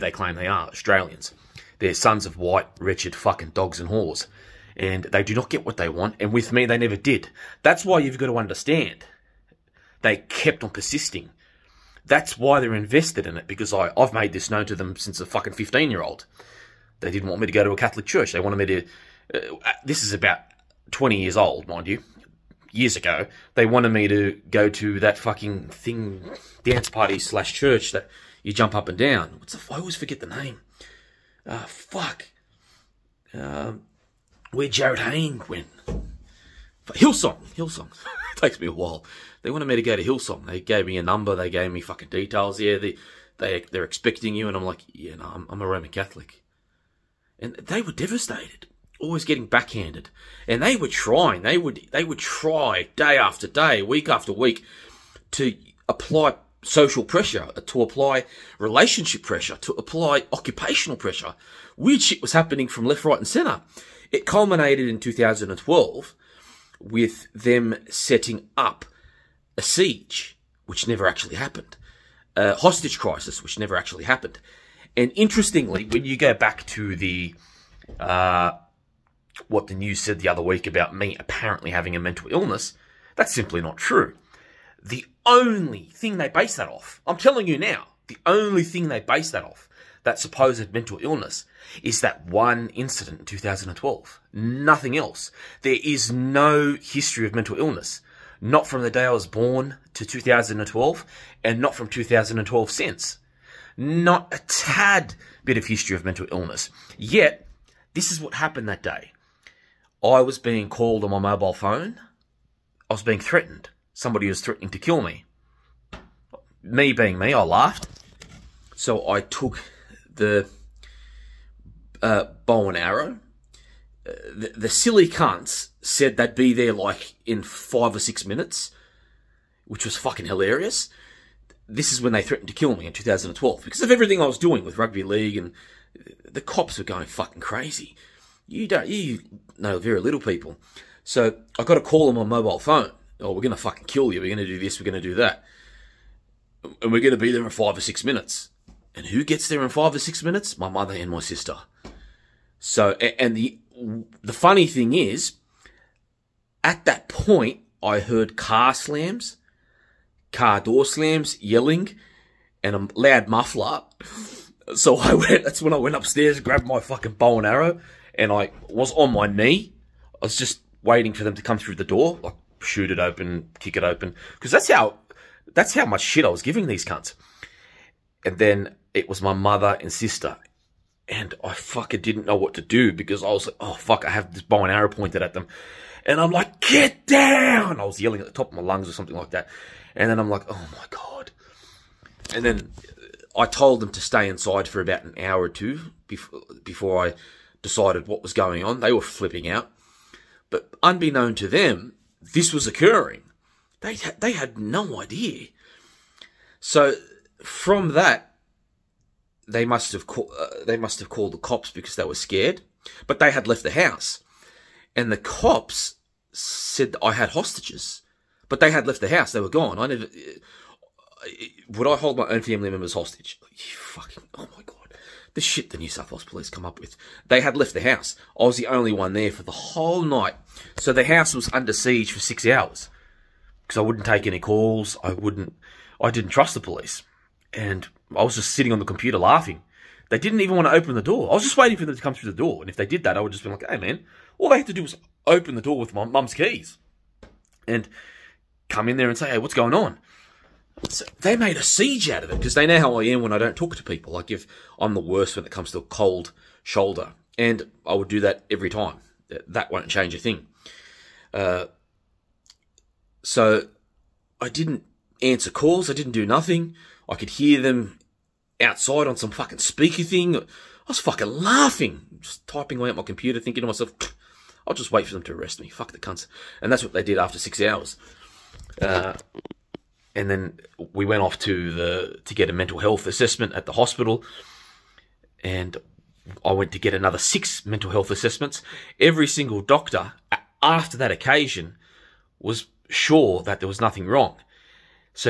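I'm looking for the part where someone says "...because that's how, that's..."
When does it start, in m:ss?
2:54.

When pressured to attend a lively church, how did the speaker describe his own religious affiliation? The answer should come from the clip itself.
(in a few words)
Roman Catholic.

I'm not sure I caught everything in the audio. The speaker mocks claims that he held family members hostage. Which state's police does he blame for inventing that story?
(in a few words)
New South Wales.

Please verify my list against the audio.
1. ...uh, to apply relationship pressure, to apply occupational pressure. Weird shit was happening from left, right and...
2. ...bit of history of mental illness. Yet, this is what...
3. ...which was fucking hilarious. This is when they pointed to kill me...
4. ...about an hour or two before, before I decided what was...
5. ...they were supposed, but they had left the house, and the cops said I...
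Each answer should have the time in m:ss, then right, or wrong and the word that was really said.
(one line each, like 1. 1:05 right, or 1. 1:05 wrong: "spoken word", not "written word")
1. 0:57 right
2. 1:45 right
3. 2:09 wrong: "threatened", not "pointed"
4. 3:14 right
5. 3:31 wrong: "scared", not "supposed".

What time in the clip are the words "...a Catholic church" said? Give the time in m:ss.
0:17.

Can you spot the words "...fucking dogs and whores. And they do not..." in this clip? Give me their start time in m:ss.
0:03.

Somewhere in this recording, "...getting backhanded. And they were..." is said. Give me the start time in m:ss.
0:49.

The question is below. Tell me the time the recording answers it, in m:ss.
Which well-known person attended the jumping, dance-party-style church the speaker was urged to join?
0:34.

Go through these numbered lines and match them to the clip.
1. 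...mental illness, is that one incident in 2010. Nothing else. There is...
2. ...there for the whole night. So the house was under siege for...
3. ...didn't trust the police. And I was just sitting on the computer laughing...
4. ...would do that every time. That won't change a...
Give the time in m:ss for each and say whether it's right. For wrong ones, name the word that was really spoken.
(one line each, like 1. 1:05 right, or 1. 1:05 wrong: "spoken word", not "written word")
1. 1:30 wrong: "2012", not "2010"
2. 3:49 right
3. 3:56 right
4. 4:17 right.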